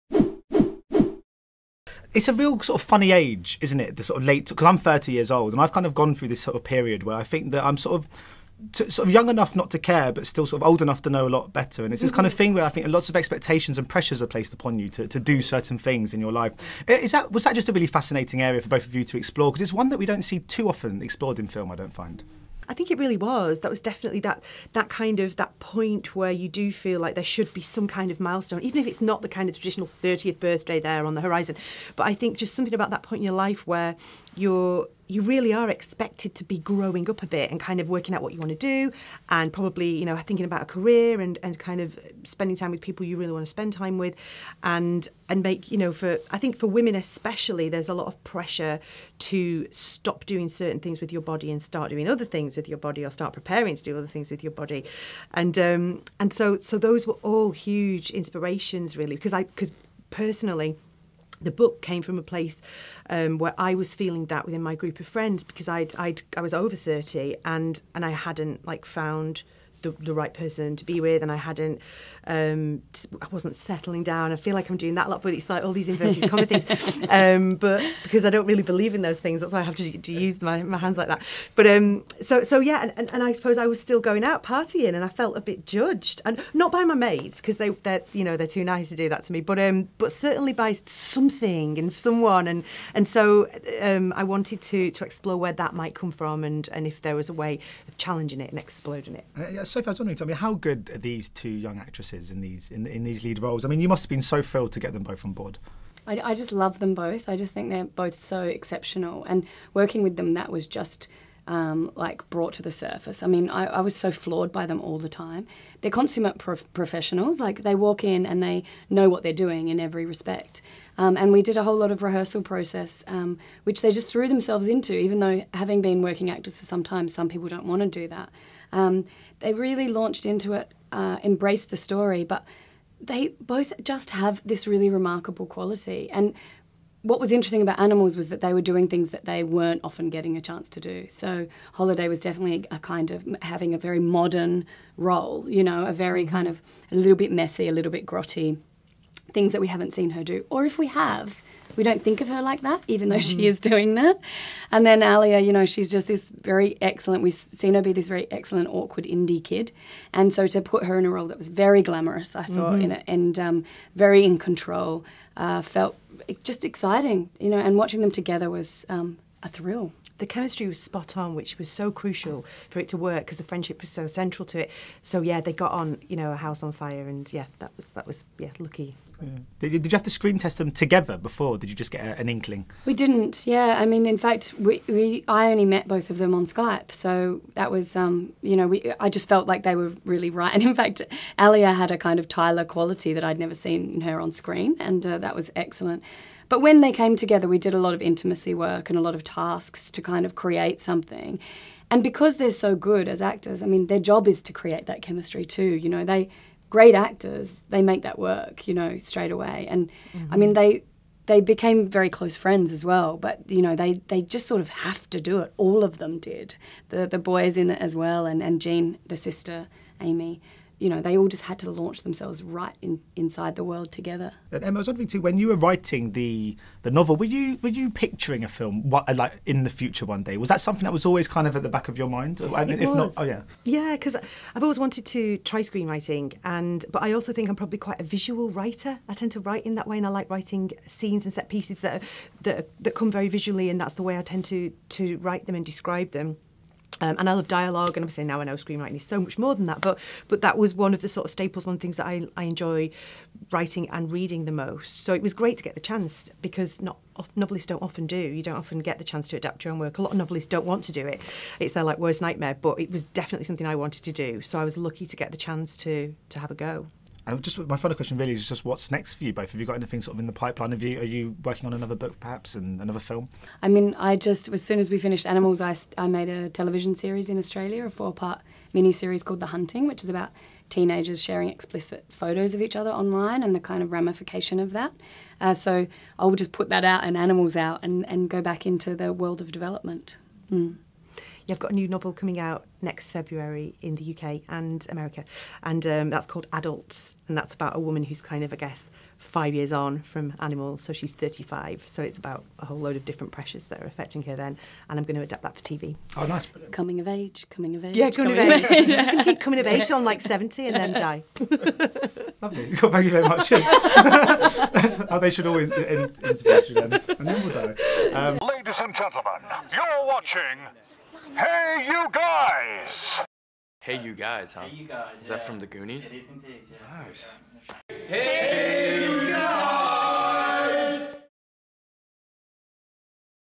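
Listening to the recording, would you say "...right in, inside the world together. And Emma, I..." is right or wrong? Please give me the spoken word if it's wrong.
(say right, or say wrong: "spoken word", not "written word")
right.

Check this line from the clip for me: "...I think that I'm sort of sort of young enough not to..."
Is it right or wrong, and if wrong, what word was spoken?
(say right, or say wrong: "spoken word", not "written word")
right.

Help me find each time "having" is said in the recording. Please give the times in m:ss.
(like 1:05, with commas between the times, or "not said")
2:05, 2:23.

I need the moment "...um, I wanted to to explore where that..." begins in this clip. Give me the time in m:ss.
1:33.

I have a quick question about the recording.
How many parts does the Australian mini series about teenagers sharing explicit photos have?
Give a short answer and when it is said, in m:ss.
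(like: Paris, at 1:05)
4, at 4:37.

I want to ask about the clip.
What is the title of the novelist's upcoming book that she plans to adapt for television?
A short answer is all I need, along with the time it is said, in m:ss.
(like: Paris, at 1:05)
Adults, at 4:56.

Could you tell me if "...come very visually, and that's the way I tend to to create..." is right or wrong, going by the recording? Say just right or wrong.
wrong.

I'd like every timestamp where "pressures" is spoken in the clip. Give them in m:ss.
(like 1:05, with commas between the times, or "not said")
0:13, 0:48, 5:03.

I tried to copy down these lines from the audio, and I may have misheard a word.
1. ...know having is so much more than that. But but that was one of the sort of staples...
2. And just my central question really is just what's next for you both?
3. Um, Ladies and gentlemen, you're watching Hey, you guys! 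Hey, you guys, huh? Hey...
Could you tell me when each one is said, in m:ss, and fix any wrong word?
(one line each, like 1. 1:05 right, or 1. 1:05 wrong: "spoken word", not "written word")
1. 4:08 wrong: "screenwriting", not "having"
2. 4:27 wrong: "final", not "central"
3. 5:18 right.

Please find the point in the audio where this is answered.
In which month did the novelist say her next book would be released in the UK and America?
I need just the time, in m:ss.
4:53.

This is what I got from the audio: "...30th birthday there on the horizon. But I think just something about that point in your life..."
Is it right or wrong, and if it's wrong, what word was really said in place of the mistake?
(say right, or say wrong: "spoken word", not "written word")
right.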